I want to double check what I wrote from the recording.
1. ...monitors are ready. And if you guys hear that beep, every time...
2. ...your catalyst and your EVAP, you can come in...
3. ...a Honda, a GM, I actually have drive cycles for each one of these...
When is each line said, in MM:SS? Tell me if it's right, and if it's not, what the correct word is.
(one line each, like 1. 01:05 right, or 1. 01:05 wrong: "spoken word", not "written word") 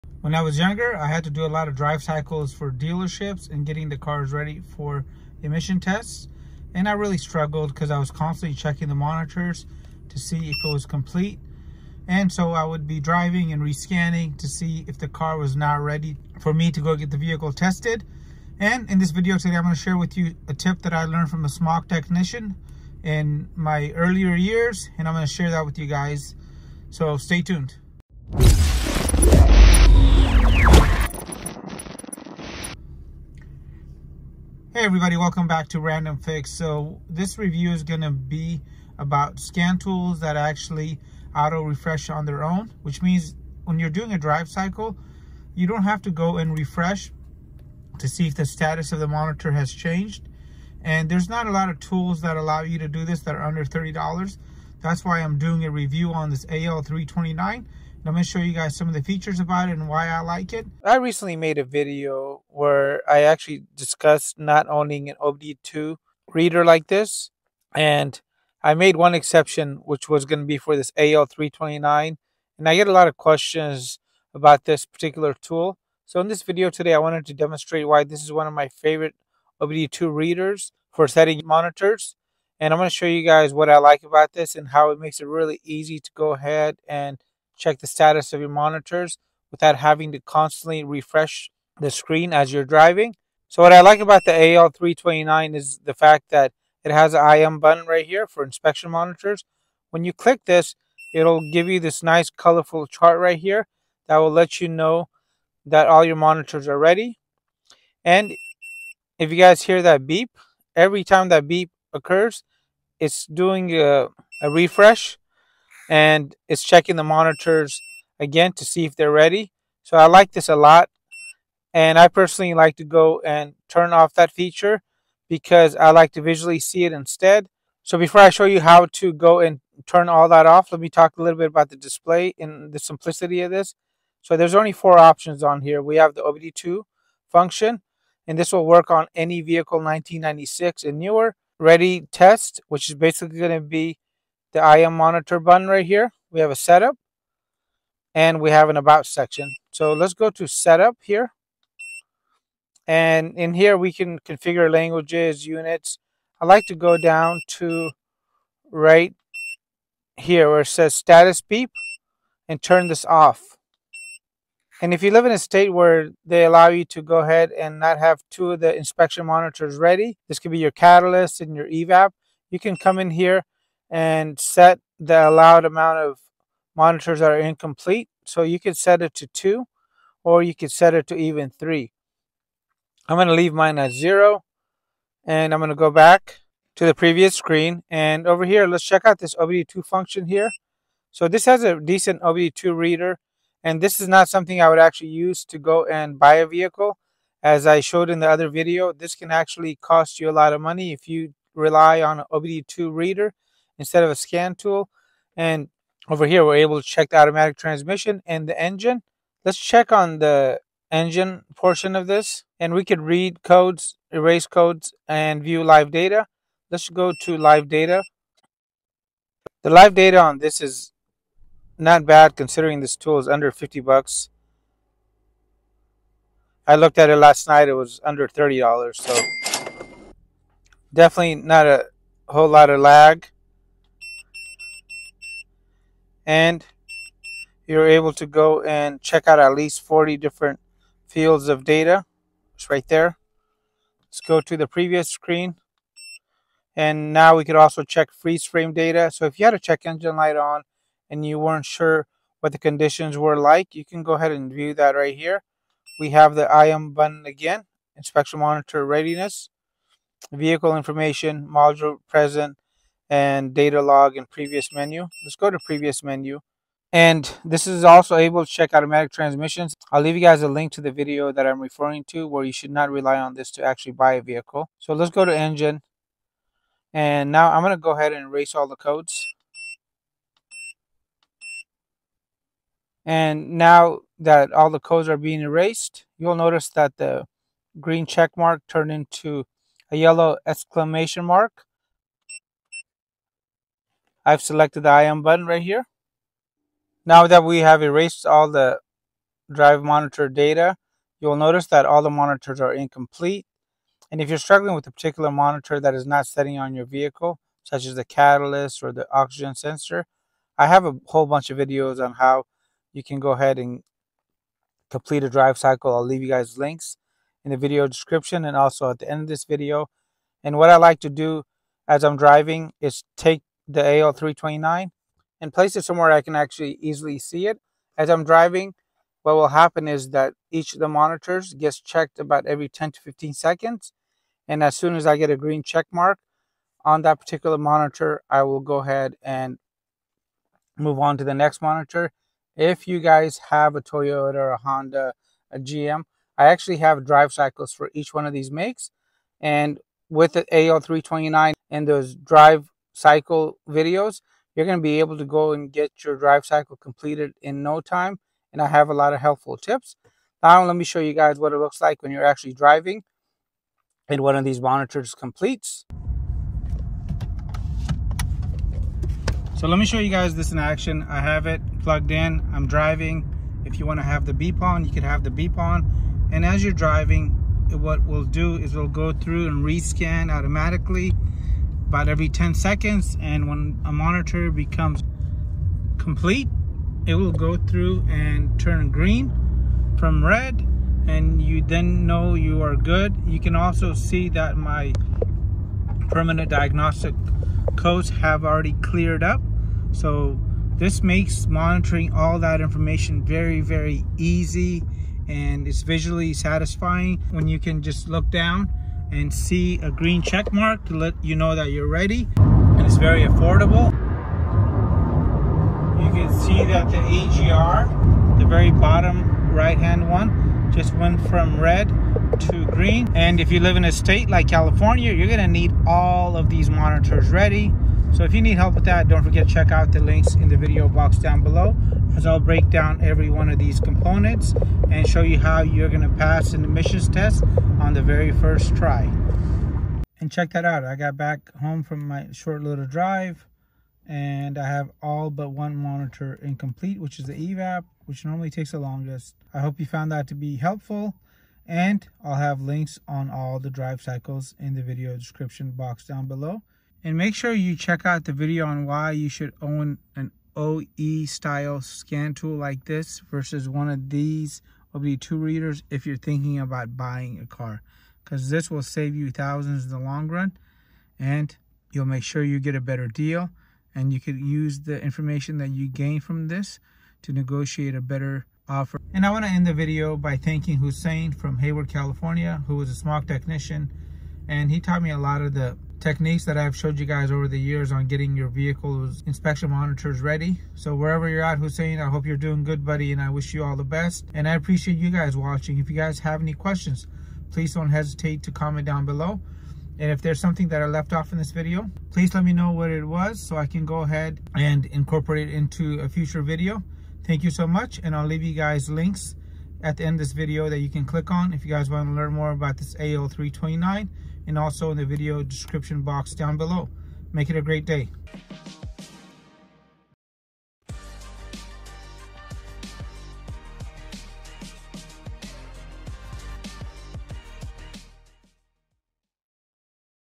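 1. 01:46 right
2. 02:50 right
3. 05:44 right.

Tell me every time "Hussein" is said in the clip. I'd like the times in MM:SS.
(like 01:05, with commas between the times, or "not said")
08:00, 08:11.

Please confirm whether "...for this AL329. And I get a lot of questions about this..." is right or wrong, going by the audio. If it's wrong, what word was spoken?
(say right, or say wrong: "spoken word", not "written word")
right.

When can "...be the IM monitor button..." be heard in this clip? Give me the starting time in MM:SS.
02:23.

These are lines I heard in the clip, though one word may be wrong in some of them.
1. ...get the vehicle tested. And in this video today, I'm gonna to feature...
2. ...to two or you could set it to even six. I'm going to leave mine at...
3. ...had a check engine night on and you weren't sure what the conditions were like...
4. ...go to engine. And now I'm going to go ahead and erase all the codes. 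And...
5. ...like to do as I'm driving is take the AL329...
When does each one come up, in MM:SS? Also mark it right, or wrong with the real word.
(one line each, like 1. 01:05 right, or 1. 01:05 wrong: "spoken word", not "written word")
1. 00:16 wrong: "share", not "feature"
2. 02:59 wrong: "three", not "six"
3. 04:09 wrong: "light", not "night"
4. 04:35 right
5. 05:20 right.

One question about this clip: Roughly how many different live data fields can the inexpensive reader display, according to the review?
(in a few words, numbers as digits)
40.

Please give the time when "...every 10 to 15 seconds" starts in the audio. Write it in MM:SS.
05:32.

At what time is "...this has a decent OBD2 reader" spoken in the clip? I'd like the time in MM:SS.
03:11.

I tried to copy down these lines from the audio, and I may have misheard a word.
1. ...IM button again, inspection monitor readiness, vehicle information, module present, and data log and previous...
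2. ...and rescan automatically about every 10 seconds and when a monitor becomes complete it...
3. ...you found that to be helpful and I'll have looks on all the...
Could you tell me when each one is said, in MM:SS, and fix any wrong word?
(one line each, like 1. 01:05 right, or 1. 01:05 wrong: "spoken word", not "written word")
1. 04:16 right
2. 06:19 right
3. 07:29 wrong: "links", not "looks".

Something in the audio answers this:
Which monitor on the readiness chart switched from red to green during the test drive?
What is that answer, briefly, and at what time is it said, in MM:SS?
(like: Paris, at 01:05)
EGR, at 06:56.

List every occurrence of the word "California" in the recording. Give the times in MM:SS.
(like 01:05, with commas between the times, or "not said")
07:04, 08:01.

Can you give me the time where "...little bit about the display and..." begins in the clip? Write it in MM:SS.
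02:11.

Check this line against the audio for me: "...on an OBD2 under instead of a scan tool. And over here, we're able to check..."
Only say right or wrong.
wrong.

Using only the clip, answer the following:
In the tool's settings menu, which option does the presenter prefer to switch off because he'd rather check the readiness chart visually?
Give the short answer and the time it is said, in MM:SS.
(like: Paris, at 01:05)
Status beep, at 02:40.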